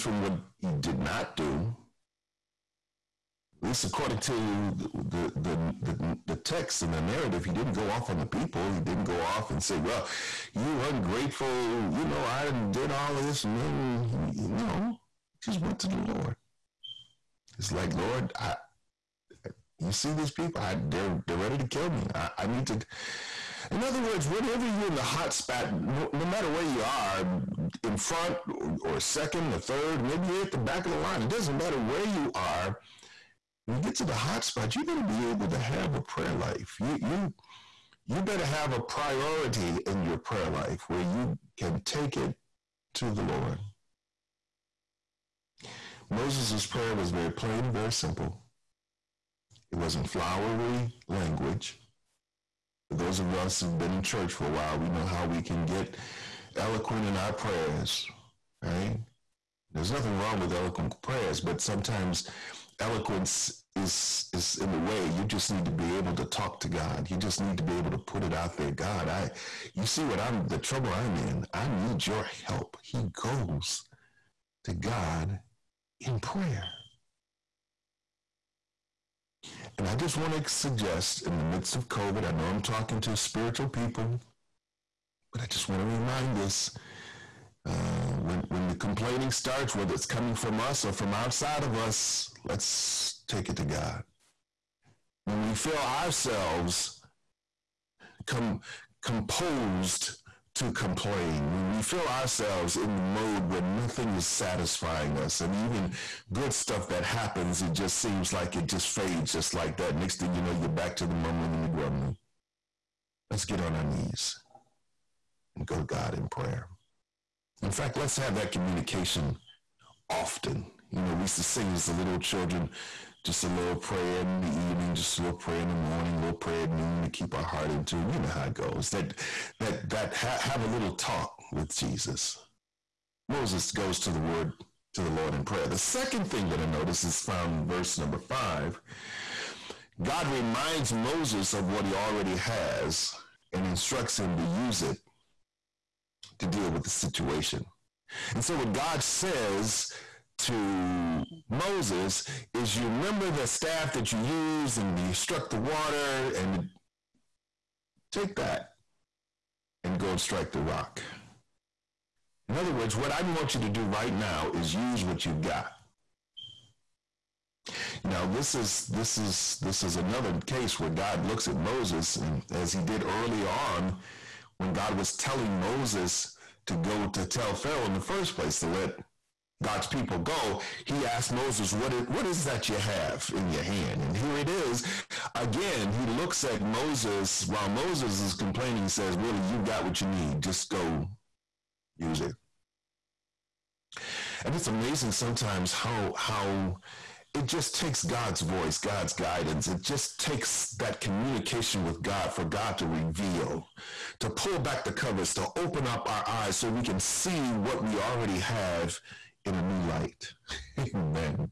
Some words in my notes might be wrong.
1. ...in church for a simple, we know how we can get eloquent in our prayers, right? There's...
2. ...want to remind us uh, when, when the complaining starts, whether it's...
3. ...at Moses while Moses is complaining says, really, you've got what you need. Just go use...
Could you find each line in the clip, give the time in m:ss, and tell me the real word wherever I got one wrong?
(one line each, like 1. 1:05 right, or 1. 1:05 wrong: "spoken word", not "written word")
1. 0:53 wrong: "while", not "simple"
2. 1:25 right
3. 3:06 right.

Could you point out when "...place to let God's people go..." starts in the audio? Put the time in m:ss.
2:58.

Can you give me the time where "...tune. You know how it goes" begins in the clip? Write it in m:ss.
2:07.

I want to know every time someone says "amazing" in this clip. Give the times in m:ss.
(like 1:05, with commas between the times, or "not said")
3:14.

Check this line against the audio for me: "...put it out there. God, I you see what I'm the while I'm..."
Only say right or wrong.
wrong.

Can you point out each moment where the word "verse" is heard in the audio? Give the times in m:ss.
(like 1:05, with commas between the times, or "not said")
2:17.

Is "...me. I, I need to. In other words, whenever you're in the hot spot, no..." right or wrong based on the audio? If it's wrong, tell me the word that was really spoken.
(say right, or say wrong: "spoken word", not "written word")
right.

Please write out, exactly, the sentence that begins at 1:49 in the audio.
Next thing you know, you're back to the mumbling and the grumbling.